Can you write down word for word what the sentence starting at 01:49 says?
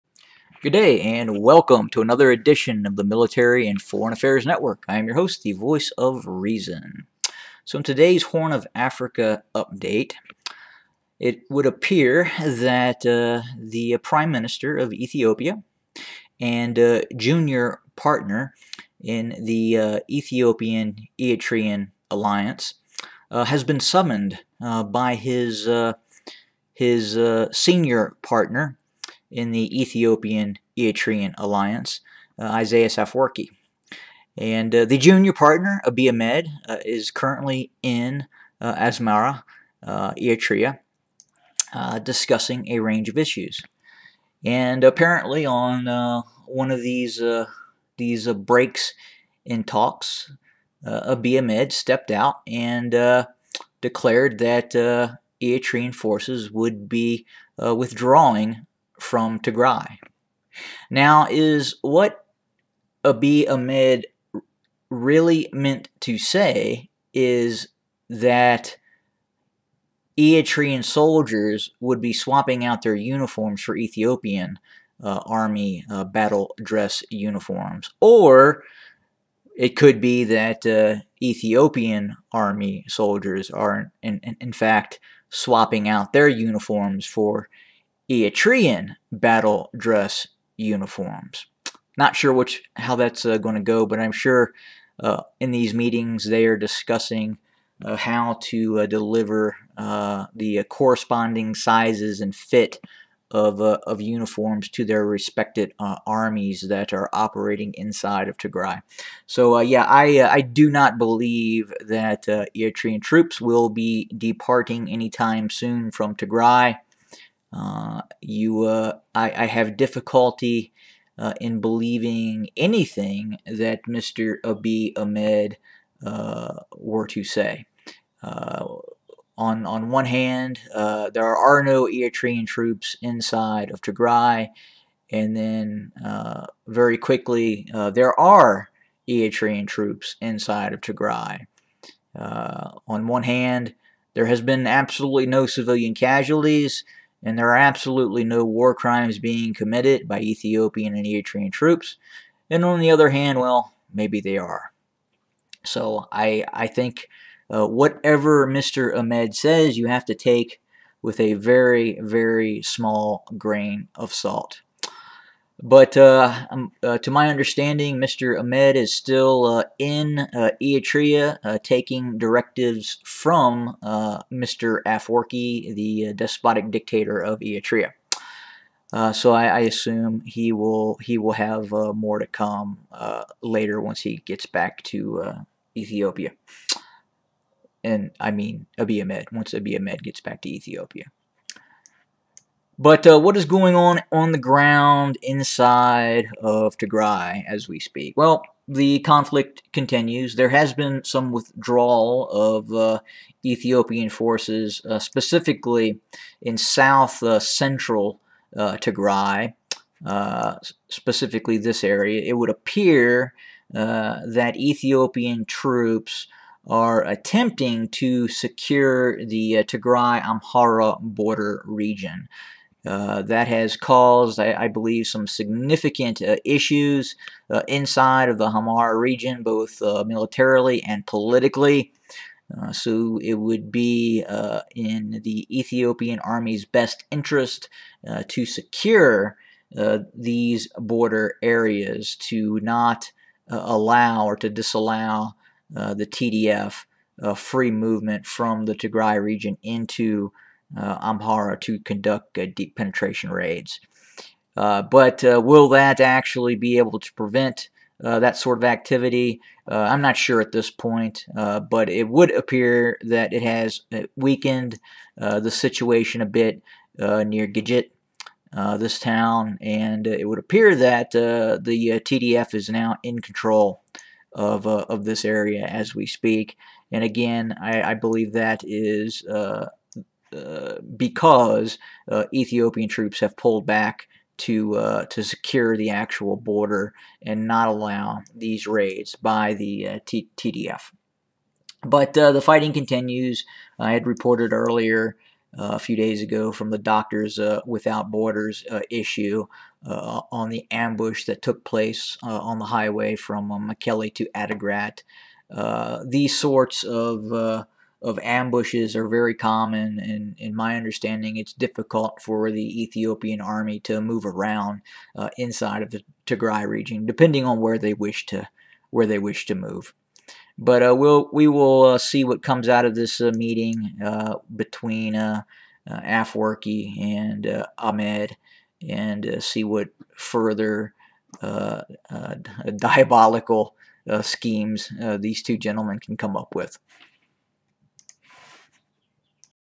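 So yeah, I, I do not believe that Eritrean troops will be departing anytime soon from Tigray.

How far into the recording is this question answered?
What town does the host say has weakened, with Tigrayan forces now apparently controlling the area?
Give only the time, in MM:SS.
04:27.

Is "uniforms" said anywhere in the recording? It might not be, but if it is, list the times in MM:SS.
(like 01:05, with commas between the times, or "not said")
01:12, 01:17, 01:26, 01:30, 01:44.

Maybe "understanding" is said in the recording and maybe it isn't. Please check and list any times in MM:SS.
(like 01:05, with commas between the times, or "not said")
02:47, 05:10.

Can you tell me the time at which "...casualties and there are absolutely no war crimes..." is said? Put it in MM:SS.
02:25.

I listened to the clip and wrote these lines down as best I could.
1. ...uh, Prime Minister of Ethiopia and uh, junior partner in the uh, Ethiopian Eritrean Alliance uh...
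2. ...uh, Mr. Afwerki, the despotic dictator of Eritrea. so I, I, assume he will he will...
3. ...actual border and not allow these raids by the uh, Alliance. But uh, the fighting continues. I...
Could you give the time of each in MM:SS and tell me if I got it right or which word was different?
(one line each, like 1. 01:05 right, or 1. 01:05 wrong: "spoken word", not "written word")
1. 00:13 right
2. 02:53 right
3. 04:45 wrong: "TDF", not "Alliance".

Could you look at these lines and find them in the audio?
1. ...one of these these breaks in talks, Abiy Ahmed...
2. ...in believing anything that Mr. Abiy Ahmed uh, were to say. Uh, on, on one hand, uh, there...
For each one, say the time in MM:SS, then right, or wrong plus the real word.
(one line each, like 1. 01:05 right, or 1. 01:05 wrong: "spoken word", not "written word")
1. 00:46 right
2. 02:01 right.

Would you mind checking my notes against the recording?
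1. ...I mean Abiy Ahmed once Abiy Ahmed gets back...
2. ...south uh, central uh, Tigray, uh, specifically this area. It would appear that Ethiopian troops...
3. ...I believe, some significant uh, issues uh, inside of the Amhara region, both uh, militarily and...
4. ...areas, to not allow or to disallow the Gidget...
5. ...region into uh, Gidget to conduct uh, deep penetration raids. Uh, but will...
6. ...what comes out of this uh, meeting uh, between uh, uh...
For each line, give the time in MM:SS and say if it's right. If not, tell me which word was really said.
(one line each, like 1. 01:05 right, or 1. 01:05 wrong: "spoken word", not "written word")
1. 03:08 right
2. 03:26 right
3. 03:44 right
4. 04:01 wrong: "TDF", not "Gidget"
5. 04:09 wrong: "Amhara", not "Gidget"
6. 05:22 right.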